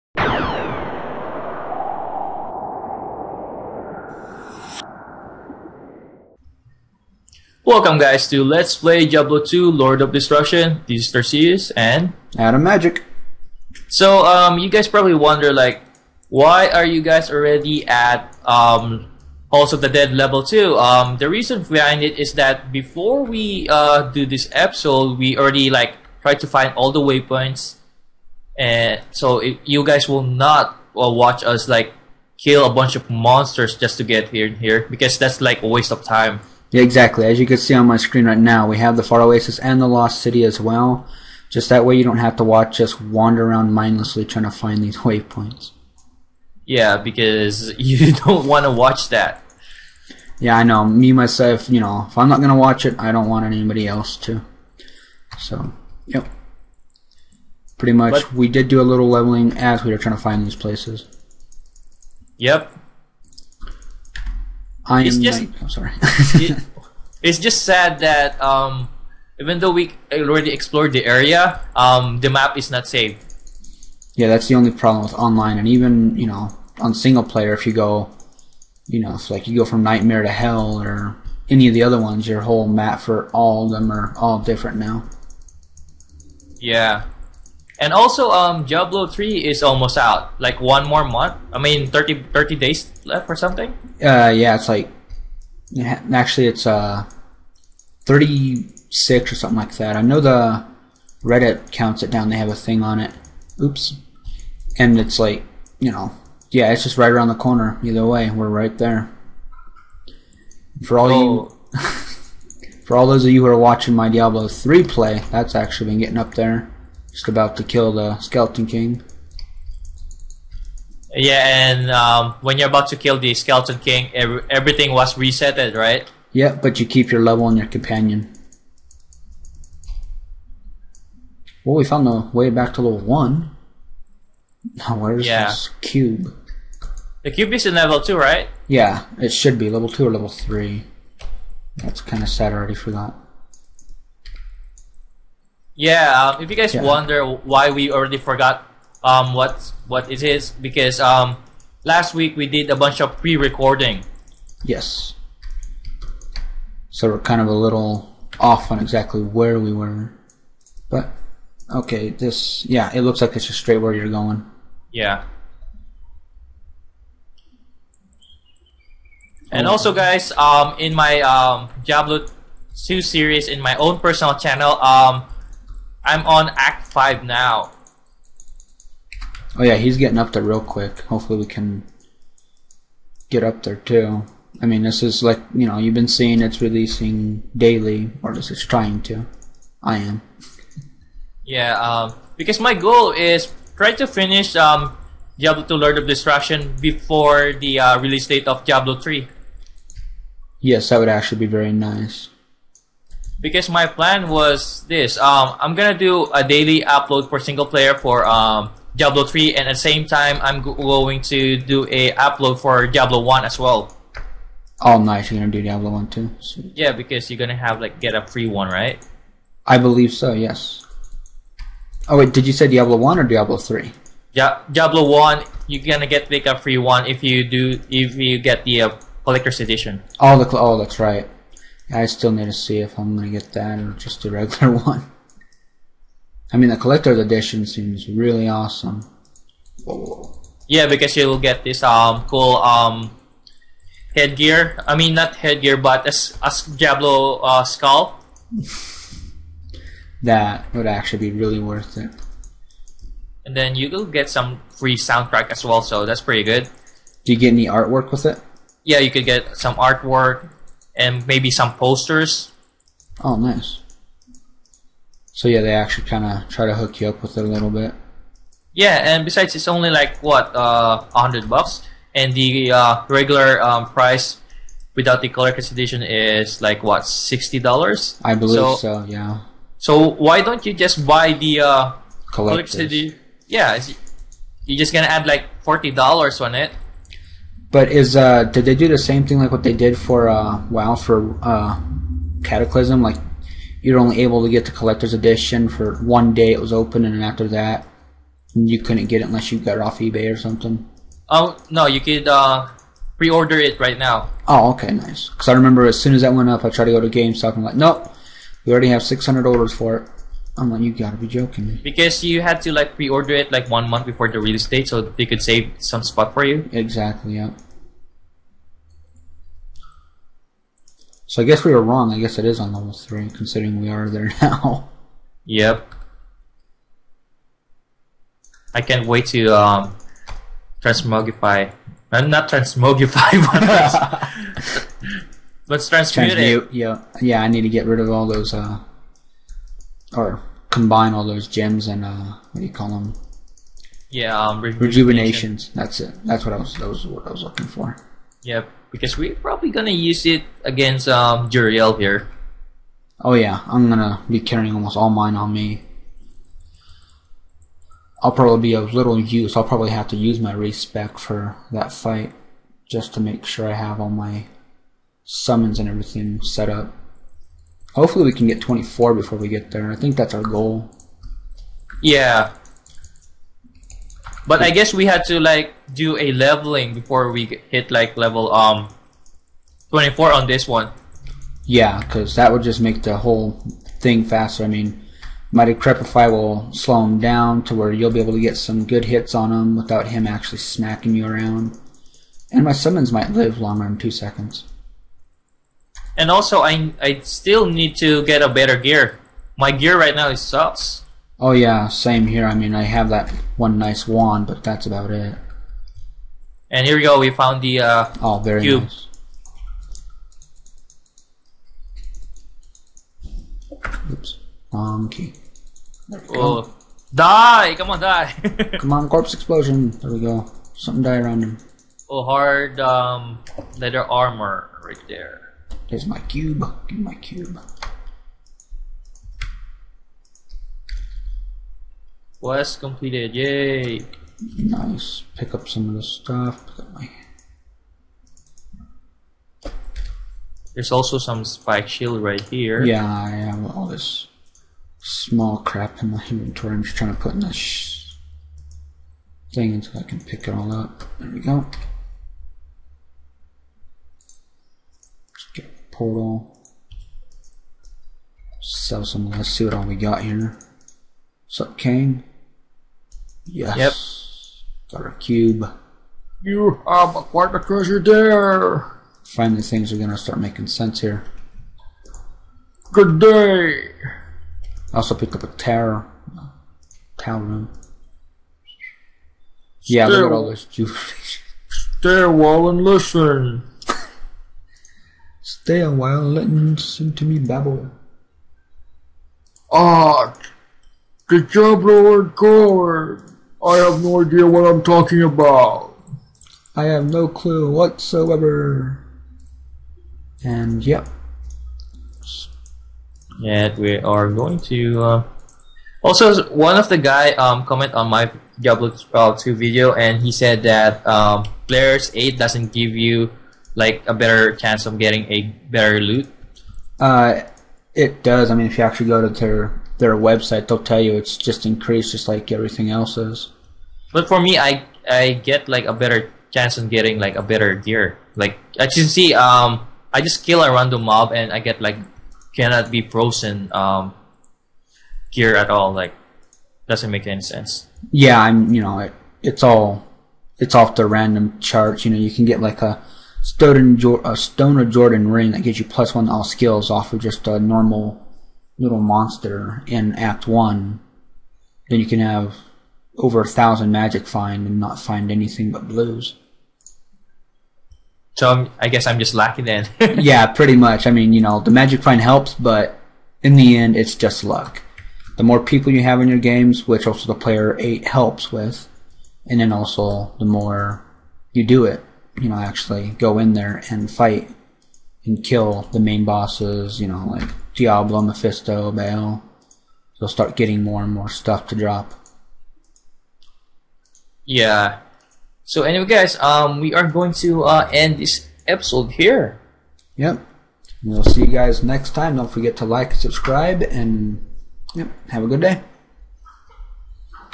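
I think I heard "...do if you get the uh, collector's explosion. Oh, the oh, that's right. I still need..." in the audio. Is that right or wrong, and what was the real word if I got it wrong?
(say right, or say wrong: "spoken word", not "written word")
wrong: "edition", not "explosion".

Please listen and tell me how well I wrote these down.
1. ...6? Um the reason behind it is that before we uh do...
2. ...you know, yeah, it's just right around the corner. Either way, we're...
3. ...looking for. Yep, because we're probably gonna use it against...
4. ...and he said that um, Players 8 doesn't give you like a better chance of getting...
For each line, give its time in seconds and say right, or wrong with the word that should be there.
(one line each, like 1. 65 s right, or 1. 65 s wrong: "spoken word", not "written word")
1. 20 s wrong: "2", not "6"
2. 105 s right
3. 347 s right
4. 509 s right.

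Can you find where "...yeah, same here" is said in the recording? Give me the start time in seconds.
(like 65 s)
401 s.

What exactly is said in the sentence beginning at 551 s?
Then you can have over a thousand magic find and not find anything but blues.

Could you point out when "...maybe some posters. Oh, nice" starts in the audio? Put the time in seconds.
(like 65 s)
261 s.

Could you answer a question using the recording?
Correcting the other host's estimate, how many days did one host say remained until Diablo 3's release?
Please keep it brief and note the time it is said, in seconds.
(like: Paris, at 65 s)
36, at 98 s.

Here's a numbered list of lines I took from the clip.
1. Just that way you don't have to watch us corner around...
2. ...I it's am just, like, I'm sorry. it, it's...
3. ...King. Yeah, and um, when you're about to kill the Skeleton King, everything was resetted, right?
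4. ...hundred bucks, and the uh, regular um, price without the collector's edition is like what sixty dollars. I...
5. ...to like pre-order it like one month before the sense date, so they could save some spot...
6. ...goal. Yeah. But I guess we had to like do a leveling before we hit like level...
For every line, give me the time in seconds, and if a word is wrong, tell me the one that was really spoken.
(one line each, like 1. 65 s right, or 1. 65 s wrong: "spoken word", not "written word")
1. 41 s wrong: "wander", not "corner"
2. 64 s right
3. 118 s right
4. 271 s right
5. 312 s wrong: "release", not "sense"
6. 370 s right.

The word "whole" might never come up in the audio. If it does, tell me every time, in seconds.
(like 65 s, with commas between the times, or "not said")
82 s, 383 s.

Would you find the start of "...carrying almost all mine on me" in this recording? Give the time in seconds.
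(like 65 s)
354 s.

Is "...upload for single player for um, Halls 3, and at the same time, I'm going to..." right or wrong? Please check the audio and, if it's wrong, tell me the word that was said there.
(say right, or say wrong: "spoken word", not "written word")
wrong: "Diablo", not "Halls".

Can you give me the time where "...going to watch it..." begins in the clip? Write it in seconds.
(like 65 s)
52 s.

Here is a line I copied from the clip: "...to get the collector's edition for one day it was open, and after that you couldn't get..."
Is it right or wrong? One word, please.
right.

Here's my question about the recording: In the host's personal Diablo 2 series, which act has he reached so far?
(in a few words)
Act 5.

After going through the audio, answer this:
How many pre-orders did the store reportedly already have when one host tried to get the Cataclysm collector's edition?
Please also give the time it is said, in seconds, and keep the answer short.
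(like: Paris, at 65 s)
600, at 309 s.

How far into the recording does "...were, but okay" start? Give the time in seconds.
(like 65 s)
159 s.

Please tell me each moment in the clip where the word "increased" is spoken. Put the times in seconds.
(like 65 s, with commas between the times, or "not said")
521 s.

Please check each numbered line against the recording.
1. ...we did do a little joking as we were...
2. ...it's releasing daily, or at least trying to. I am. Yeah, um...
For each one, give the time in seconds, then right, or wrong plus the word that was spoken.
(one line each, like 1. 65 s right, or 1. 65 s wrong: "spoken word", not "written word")
1. 58 s wrong: "leveling", not "joking"
2. 186 s right.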